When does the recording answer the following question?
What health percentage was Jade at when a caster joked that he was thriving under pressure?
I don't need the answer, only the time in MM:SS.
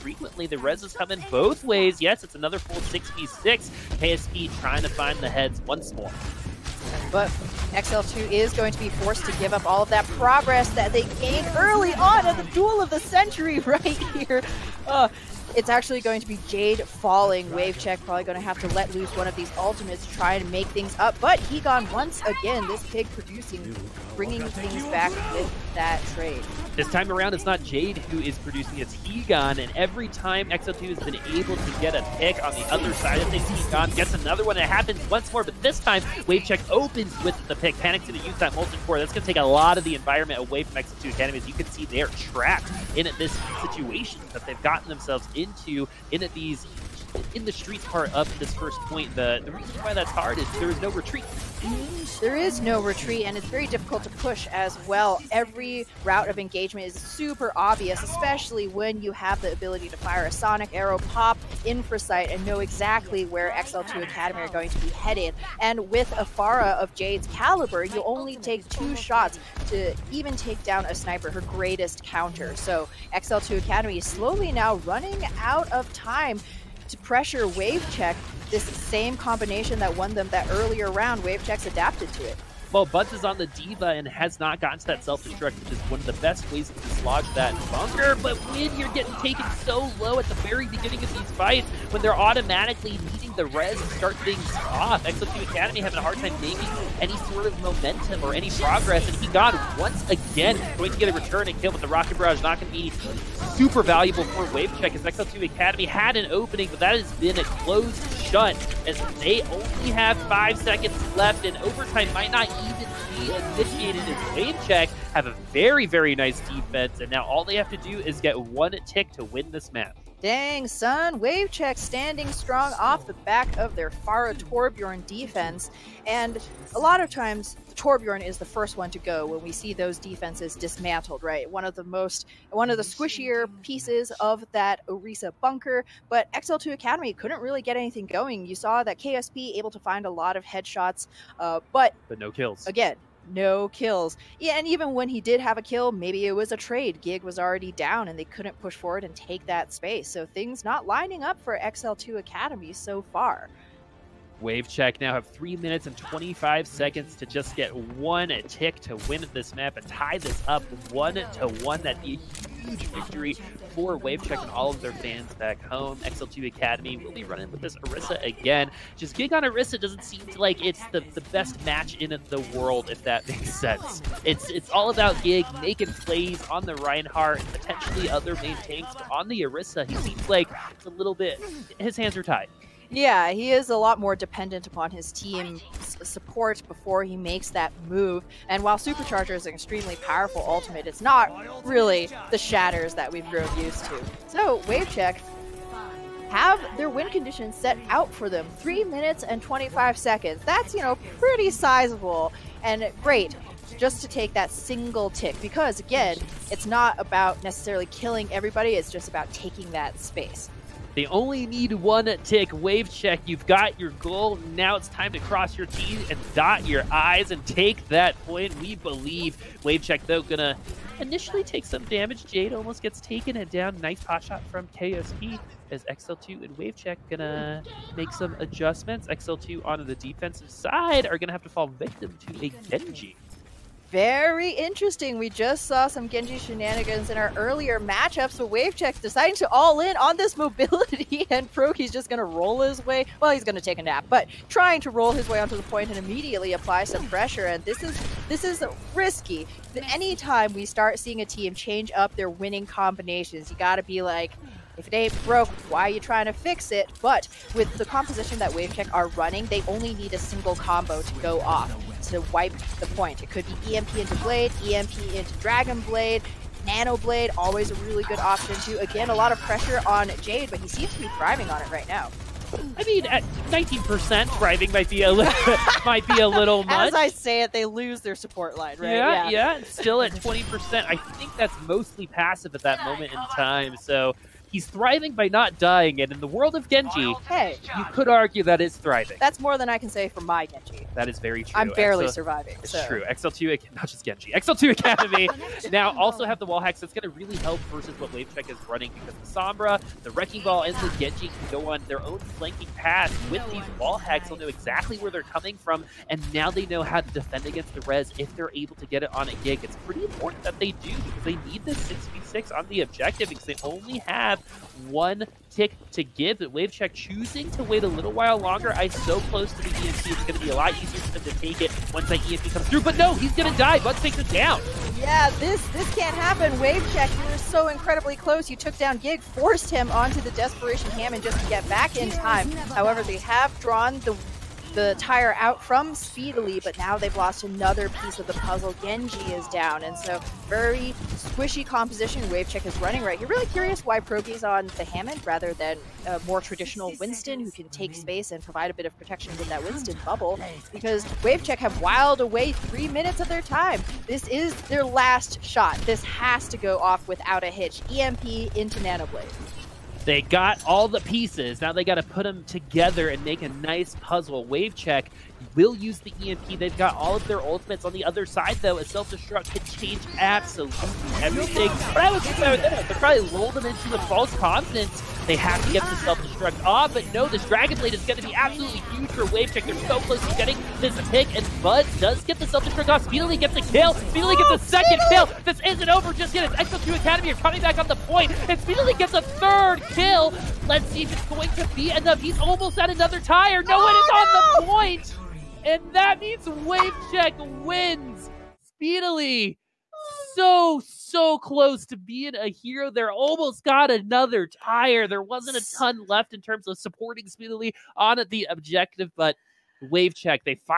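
04:33.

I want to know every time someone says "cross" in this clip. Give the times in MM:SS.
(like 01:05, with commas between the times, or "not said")
03:35.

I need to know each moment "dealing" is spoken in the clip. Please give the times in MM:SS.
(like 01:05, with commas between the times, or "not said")
not said.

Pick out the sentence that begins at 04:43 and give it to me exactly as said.
So He's thriving by not dying, and in the world of Genji, hey, you could argue that it's thriving.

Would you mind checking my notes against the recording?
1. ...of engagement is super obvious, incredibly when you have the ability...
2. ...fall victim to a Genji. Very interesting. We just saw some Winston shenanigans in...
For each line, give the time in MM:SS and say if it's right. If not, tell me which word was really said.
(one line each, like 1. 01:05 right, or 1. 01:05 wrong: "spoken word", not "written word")
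1. 00:56 wrong: "especially", not "incredibly"
2. 03:51 wrong: "Genji", not "Winston".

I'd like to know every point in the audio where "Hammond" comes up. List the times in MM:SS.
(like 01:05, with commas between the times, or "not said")
05:30, 05:44.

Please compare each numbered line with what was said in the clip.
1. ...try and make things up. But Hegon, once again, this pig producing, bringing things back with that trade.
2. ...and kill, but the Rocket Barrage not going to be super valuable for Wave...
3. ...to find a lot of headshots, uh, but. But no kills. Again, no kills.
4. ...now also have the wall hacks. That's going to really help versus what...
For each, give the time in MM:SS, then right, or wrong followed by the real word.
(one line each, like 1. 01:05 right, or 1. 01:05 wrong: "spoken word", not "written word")
1. 00:20 right
2. 01:41 right
3. 02:19 right
4. 04:55 right.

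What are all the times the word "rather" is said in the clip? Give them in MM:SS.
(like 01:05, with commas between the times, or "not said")
05:45.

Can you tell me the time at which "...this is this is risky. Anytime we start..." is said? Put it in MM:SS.
04:07.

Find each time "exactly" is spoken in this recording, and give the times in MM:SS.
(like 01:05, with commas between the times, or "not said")
01:02, 05:04.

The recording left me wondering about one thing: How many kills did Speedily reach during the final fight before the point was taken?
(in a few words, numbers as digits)
3.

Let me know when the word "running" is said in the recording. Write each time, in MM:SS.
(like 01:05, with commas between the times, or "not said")
01:14, 02:47, 04:19, 04:58, 05:42.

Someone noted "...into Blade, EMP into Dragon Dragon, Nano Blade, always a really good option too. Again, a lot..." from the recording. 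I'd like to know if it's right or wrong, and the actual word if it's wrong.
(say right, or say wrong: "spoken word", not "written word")
wrong: "Blade", not "Dragon".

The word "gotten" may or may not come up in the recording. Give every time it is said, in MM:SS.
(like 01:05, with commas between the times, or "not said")
00:44, 01:24.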